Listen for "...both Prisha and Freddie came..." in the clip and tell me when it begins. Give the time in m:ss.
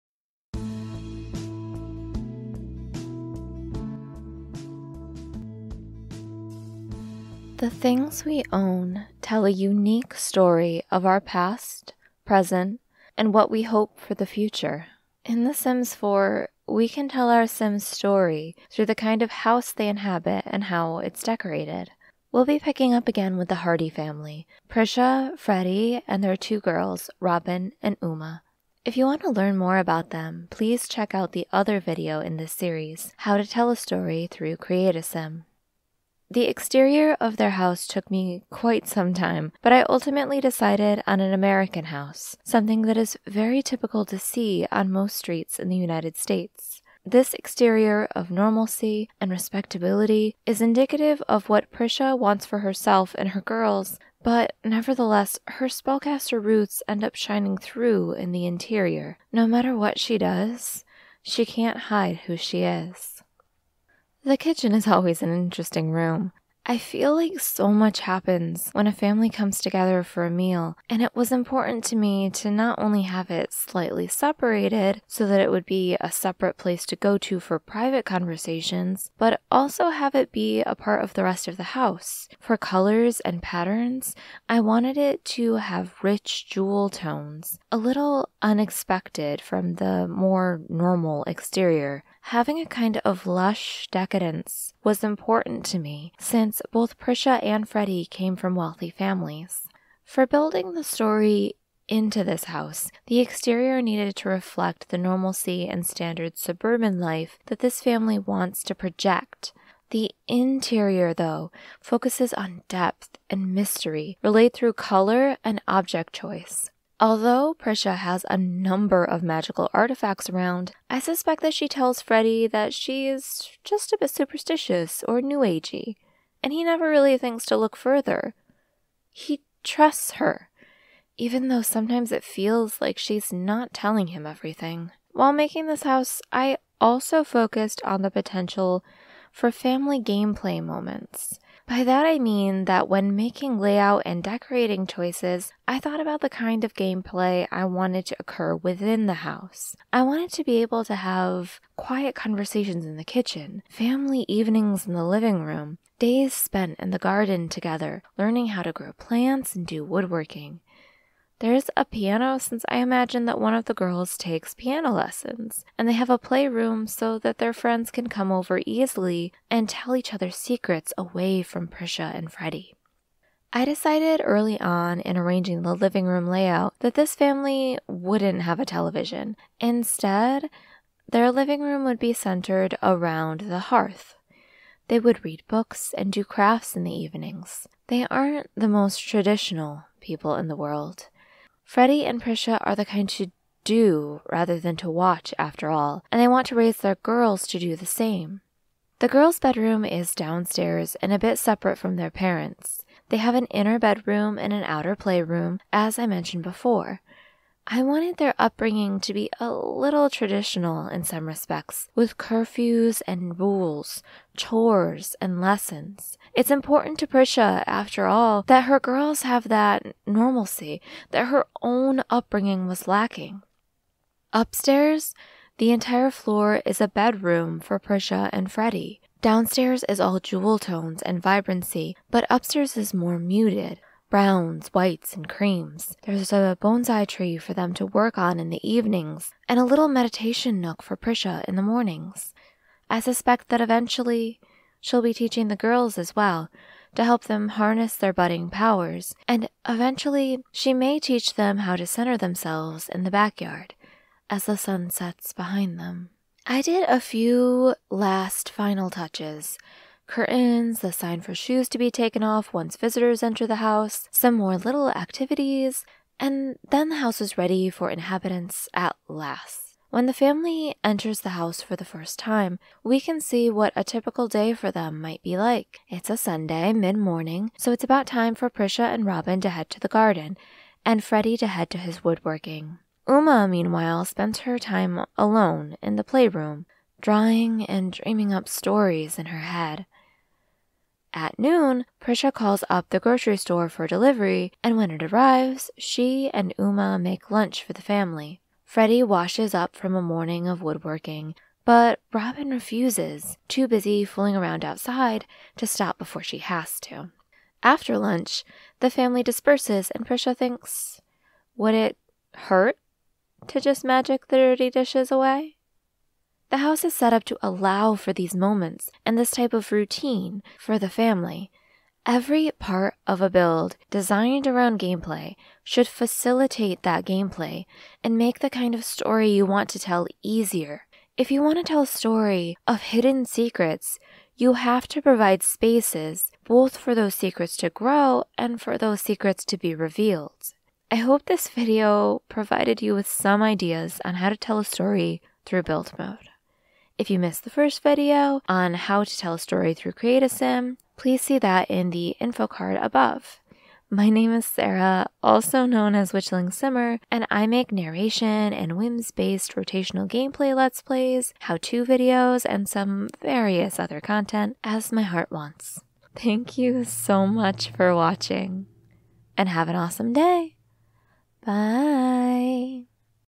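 1:36.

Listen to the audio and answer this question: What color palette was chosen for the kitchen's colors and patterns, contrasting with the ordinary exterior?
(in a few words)
Rich jewel tones.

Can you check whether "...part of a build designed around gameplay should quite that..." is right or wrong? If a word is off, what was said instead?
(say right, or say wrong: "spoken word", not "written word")
wrong: "facilitate", not "quite".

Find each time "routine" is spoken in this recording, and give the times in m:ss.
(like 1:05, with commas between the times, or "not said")
5:19.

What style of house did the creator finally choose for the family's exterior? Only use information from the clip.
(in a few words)
American house.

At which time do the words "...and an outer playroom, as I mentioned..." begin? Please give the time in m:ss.
3:24.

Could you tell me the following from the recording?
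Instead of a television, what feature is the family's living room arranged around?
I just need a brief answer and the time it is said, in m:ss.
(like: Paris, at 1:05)
The hearth, at 3:03.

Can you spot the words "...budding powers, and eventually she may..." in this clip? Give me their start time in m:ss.
4:08.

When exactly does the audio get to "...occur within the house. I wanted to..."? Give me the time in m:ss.
2:28.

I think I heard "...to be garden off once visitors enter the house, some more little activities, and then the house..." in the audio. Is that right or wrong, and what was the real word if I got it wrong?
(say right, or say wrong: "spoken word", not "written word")
wrong: "taken", not "garden".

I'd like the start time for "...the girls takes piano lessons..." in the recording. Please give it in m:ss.
2:43.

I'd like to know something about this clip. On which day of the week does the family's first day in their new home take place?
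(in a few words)
Sunday.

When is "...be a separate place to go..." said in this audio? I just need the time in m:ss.
1:15.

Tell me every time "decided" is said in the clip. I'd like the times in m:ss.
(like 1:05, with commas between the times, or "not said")
0:40, 2:53.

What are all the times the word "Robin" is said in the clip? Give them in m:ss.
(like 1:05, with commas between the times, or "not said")
0:27, 4:39, 5:02.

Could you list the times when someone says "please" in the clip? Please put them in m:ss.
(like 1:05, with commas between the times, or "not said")
0:30, 5:50.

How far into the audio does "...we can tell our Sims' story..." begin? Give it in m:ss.
0:16.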